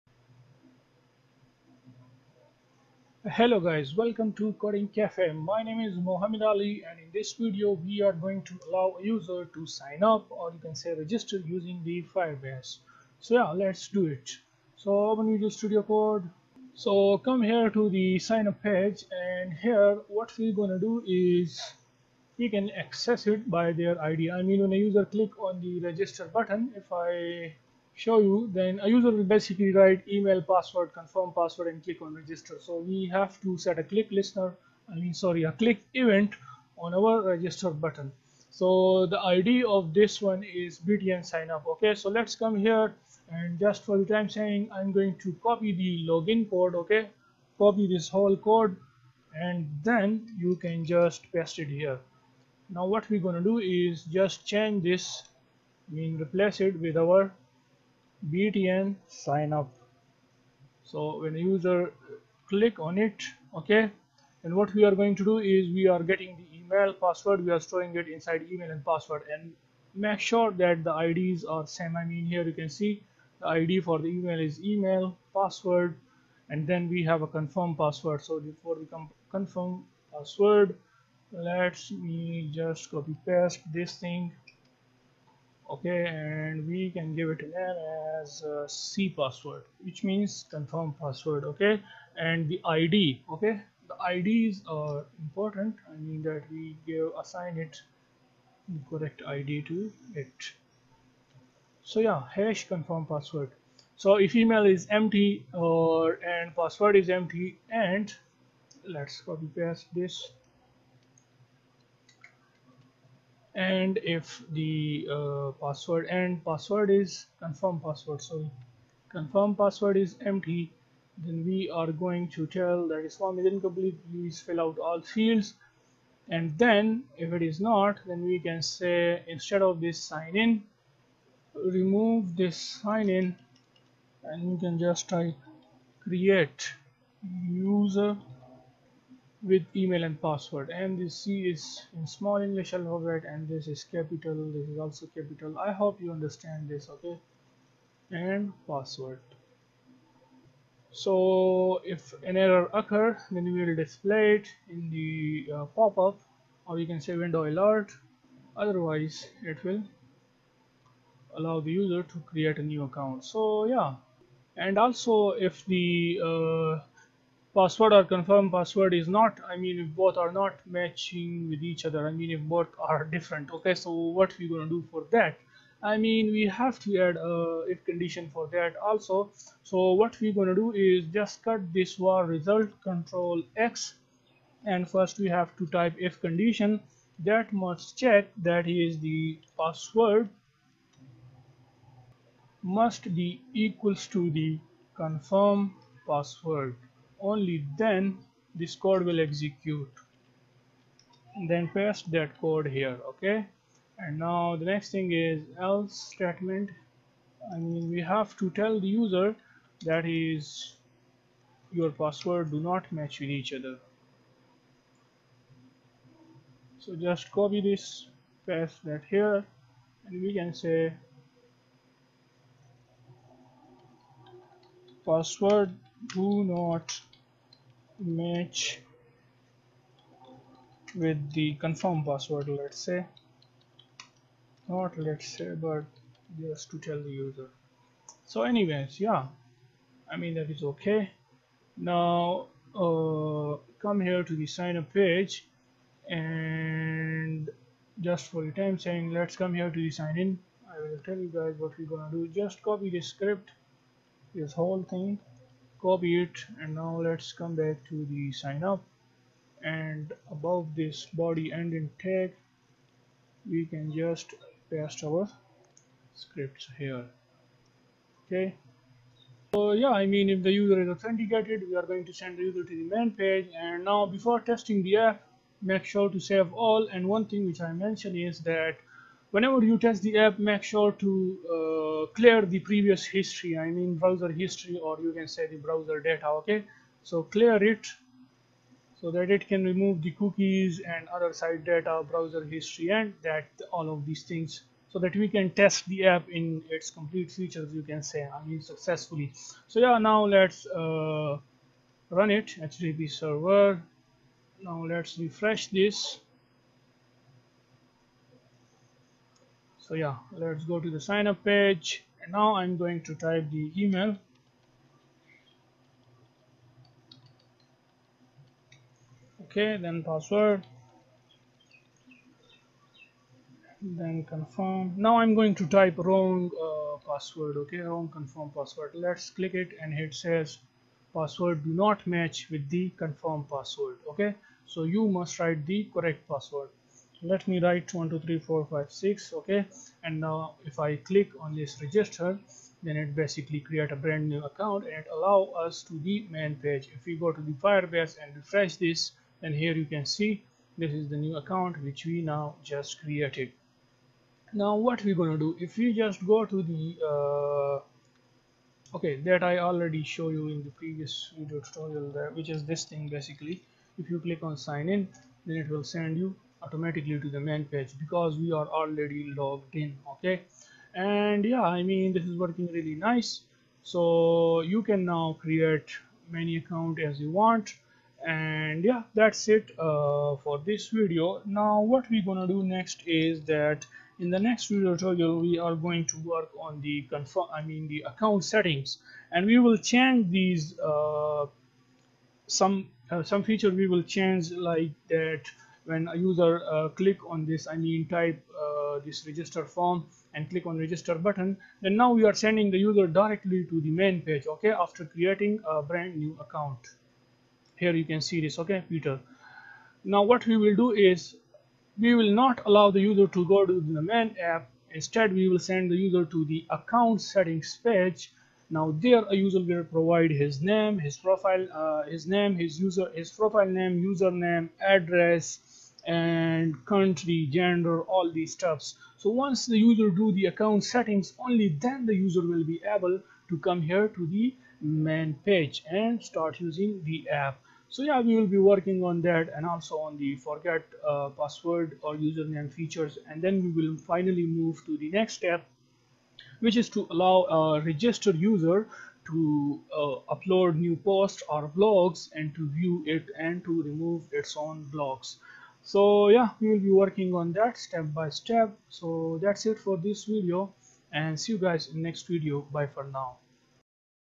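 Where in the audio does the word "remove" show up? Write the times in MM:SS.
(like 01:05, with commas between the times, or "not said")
02:11, 04:49, 07:33.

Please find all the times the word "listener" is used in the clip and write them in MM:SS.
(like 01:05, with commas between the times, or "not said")
00:34.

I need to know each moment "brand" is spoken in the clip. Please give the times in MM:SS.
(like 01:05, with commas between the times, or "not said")
05:44, 06:45.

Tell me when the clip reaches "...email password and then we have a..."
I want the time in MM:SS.
01:14.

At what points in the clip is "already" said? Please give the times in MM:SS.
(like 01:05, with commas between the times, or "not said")
05:59, 06:08.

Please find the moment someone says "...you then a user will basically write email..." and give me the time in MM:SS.
00:28.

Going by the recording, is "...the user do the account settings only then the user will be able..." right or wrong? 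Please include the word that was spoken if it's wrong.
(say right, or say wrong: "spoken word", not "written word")
right.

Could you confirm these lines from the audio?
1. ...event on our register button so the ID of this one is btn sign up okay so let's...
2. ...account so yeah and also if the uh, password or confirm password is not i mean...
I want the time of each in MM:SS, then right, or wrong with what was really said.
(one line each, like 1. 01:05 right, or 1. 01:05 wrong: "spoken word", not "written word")
1. 00:35 right
2. 02:42 right.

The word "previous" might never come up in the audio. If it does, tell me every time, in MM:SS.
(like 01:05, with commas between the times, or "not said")
04:42, 06:00.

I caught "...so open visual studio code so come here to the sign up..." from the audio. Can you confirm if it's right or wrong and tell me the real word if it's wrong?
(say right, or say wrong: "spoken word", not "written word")
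right.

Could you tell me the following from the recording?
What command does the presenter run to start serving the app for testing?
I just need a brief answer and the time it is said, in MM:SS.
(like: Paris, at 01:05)
http server, at 05:02.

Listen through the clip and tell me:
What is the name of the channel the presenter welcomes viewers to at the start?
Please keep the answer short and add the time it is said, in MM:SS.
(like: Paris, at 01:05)
Coding Cafe, at 00:04.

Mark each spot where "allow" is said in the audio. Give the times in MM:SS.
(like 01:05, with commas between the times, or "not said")
00:08, 02:41, 05:45, 06:52, 07:27.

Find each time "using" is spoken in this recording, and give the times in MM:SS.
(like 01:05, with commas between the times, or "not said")
00:11, 07:16.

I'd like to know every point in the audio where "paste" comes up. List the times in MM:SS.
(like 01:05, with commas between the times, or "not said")
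00:51, 01:23, 01:49, 03:21, 03:38, 04:24.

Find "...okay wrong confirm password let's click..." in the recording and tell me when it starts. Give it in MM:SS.
05:27.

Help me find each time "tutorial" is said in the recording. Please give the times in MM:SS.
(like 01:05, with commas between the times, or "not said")
06:01, 06:24.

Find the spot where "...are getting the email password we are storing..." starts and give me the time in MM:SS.
01:05.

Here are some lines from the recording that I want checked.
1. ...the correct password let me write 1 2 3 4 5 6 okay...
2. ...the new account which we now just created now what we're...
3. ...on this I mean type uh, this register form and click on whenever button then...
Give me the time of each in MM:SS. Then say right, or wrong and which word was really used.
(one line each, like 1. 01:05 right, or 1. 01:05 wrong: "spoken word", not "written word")
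1. 05:35 right
2. 05:51 right
3. 06:37 wrong: "register", not "whenever".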